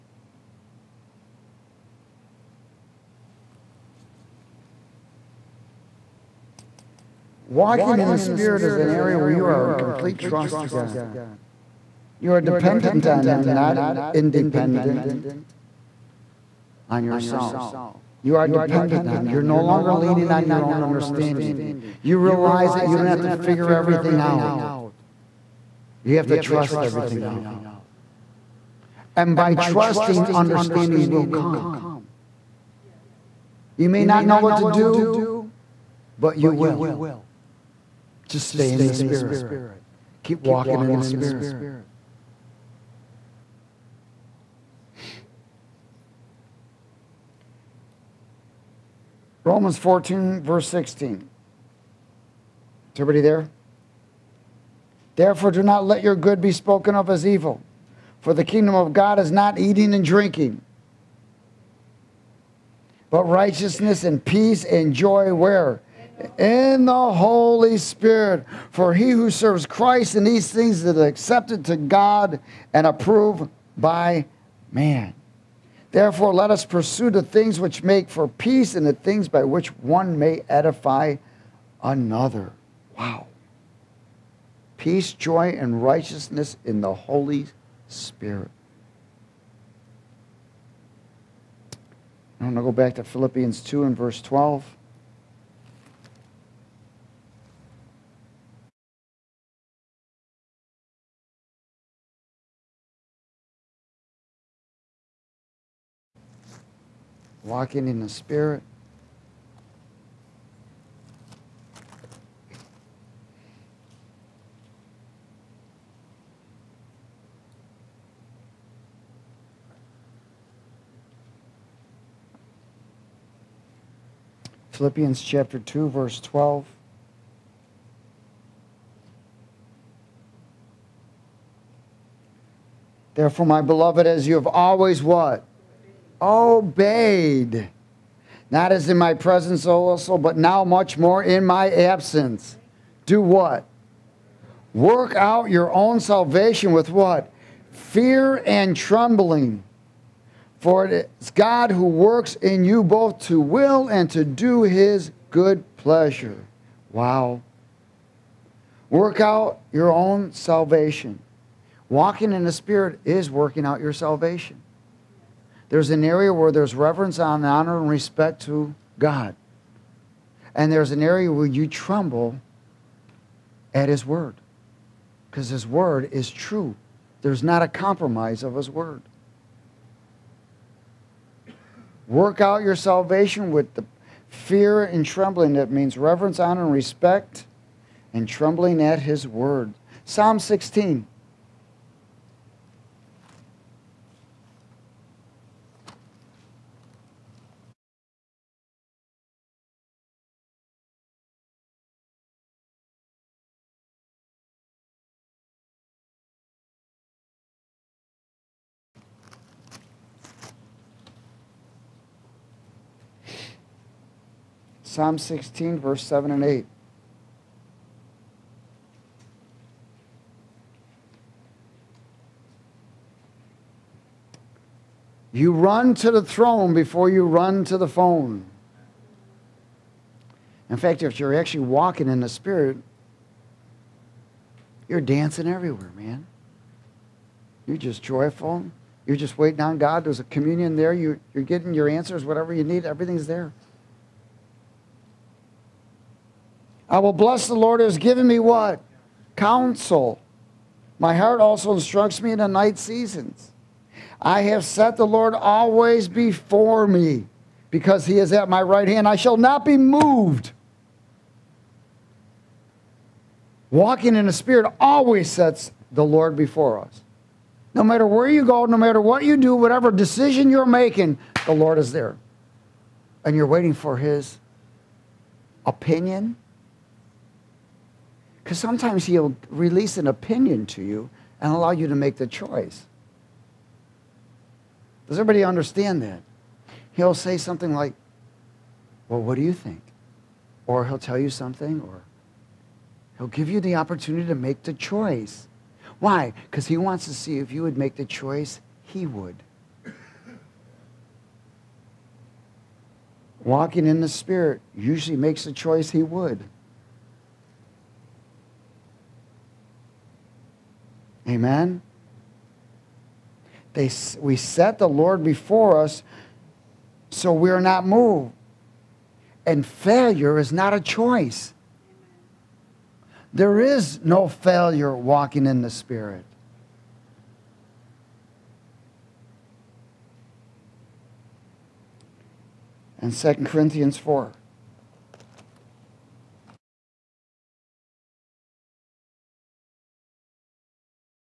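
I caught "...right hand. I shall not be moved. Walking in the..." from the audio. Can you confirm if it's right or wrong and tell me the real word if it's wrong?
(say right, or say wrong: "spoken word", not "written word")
right.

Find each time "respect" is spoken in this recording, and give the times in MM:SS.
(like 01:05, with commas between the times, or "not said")
02:47, 03:06.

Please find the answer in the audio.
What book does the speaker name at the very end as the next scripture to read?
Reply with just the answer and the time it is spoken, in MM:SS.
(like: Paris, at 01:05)
2 Corinthians, at 05:33.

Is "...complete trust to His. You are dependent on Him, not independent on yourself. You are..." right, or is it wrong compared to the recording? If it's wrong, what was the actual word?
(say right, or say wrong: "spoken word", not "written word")
wrong: "God", not "His".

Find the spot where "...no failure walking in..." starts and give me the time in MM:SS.
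05:24.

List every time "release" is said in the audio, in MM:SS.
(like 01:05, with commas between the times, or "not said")
04:39.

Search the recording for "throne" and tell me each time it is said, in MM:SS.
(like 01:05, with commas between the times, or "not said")
03:46.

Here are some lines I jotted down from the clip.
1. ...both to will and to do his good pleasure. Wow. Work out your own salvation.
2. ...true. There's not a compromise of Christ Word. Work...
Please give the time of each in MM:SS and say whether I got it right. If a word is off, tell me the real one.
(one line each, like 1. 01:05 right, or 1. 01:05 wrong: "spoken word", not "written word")
1. 02:32 right
2. 02:56 wrong: "His", not "Christ".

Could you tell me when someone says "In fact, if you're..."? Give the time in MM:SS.
03:50.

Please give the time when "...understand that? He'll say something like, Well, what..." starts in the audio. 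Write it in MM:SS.
04:45.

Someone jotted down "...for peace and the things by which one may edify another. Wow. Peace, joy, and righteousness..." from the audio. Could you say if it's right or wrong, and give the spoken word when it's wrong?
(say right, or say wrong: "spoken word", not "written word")
right.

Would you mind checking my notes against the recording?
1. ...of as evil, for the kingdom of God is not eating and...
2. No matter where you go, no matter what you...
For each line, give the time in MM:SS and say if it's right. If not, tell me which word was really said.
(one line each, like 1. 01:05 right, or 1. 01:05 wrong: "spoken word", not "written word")
1. 00:56 right
2. 04:27 right.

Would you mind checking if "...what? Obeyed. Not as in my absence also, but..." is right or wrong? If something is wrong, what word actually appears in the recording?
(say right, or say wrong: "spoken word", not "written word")
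wrong: "presence", not "absence".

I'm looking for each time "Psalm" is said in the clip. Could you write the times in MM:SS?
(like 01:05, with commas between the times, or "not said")
03:10, 03:34.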